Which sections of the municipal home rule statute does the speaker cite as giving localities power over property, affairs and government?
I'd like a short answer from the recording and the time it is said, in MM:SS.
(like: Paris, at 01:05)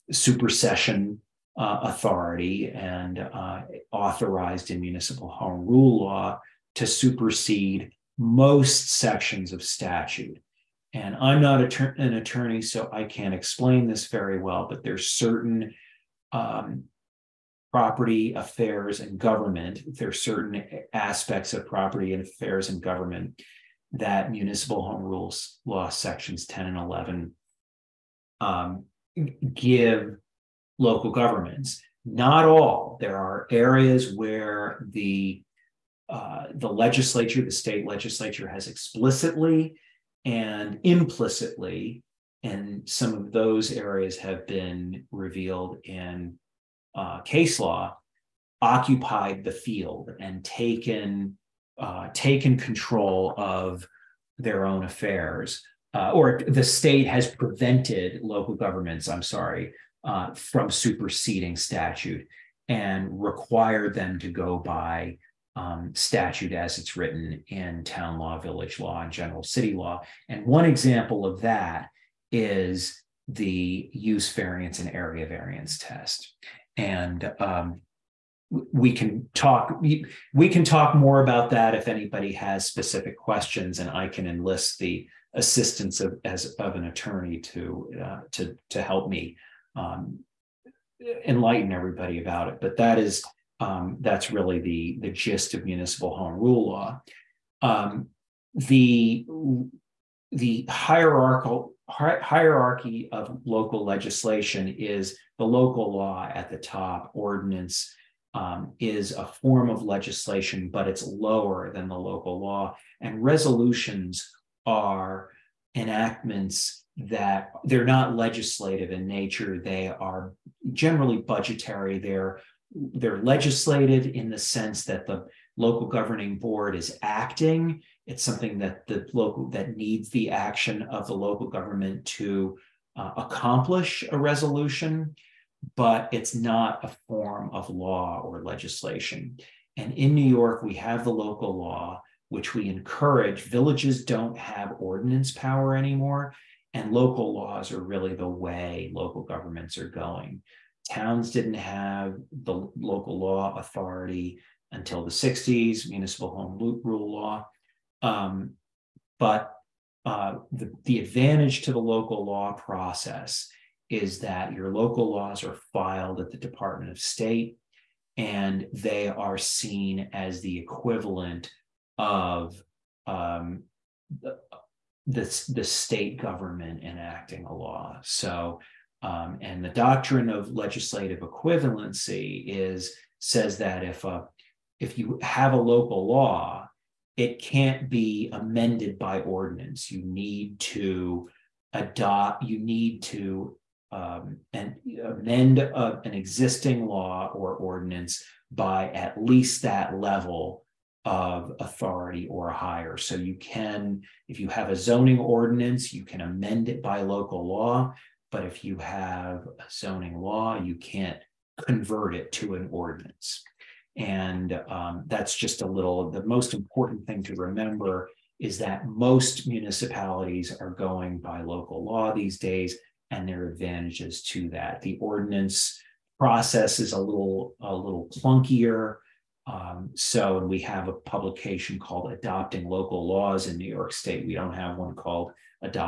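10 and 11, at 00:25.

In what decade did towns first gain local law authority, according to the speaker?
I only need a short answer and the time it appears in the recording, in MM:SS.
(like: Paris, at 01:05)
the 60s, at 02:35.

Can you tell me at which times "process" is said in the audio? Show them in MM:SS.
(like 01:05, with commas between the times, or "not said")
02:42, 03:46.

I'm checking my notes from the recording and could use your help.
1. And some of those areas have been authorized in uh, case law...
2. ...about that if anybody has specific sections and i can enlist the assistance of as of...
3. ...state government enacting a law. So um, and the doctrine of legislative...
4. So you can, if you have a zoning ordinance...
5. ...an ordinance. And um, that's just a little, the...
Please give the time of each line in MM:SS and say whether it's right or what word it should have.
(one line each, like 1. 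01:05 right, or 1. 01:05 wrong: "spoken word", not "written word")
1. 00:42 wrong: "revealed", not "authorized"
2. 01:21 wrong: "questions", not "sections"
3. 02:55 right
4. 03:22 right
5. 03:32 right.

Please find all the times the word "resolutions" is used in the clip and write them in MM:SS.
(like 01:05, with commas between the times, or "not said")
01:53, 02:14.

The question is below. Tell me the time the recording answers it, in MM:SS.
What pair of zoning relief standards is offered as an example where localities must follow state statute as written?
01:13.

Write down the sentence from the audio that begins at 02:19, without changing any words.
And in New York, we have the local law, which we encourage.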